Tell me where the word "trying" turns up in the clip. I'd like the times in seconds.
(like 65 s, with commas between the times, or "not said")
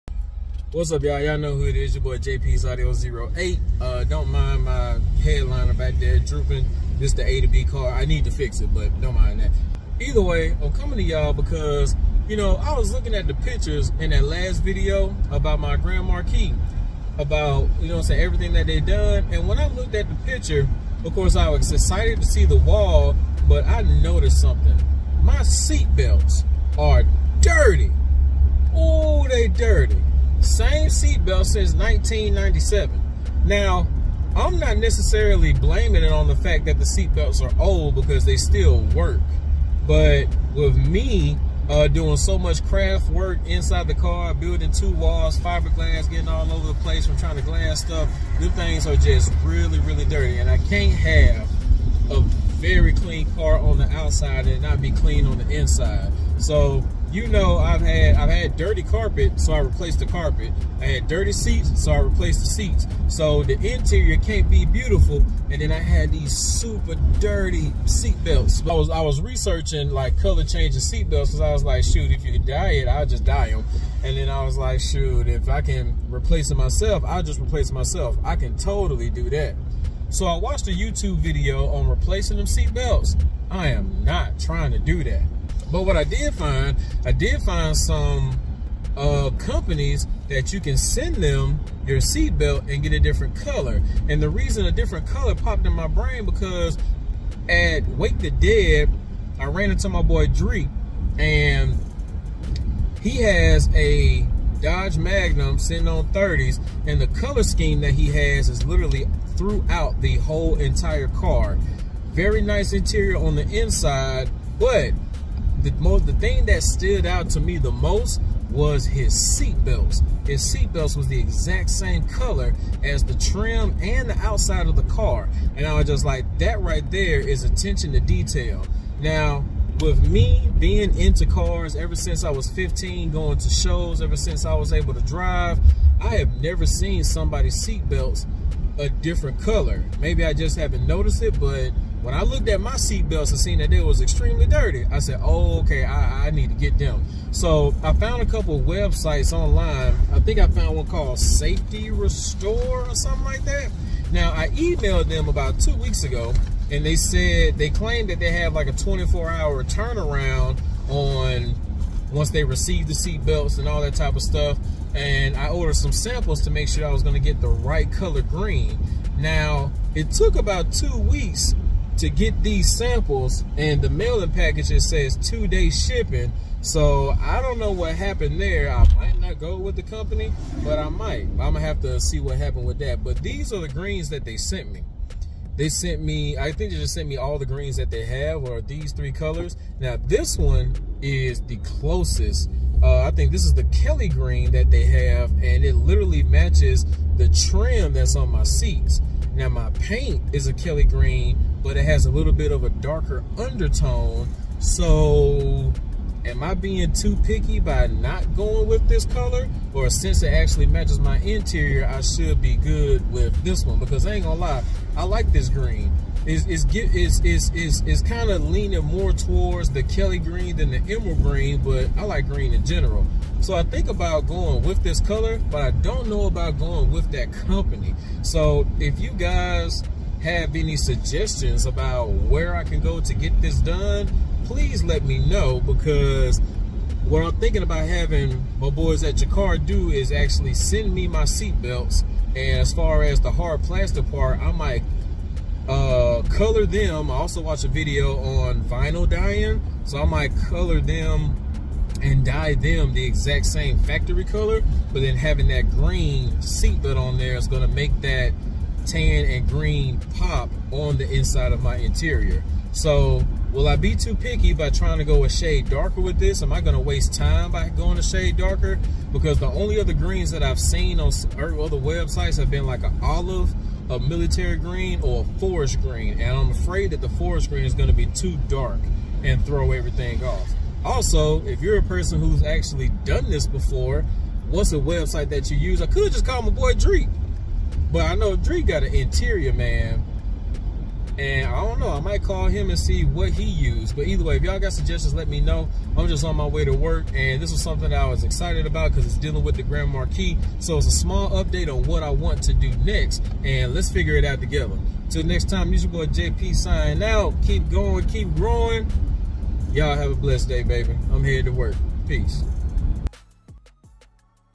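47 s, 84 s, 264 s.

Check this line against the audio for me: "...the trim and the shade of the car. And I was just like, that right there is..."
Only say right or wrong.
wrong.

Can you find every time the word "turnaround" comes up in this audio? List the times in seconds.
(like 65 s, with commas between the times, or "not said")
159 s.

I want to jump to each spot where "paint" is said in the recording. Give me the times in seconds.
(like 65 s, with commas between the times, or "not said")
199 s.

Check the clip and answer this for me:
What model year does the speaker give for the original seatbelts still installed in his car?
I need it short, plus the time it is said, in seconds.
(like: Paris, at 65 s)
1997, at 31 s.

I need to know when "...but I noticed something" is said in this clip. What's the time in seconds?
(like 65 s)
23 s.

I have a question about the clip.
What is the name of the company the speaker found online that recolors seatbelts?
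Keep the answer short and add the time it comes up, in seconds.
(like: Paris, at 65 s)
Safety Restore, at 151 s.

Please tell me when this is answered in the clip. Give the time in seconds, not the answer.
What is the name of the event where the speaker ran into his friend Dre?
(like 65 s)
97 s.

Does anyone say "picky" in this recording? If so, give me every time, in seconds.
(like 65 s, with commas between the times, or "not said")
207 s, 264 s.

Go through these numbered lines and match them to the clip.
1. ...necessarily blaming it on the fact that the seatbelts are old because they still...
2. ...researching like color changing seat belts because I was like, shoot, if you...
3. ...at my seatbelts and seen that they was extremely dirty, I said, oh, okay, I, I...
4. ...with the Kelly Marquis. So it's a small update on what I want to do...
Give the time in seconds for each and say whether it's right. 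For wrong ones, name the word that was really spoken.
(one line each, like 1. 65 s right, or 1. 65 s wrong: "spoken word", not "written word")
1. 34 s right
2. 69 s right
3. 142 s right
4. 299 s wrong: "Grand", not "Kelly".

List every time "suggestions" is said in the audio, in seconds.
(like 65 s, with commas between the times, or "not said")
230 s, 294 s.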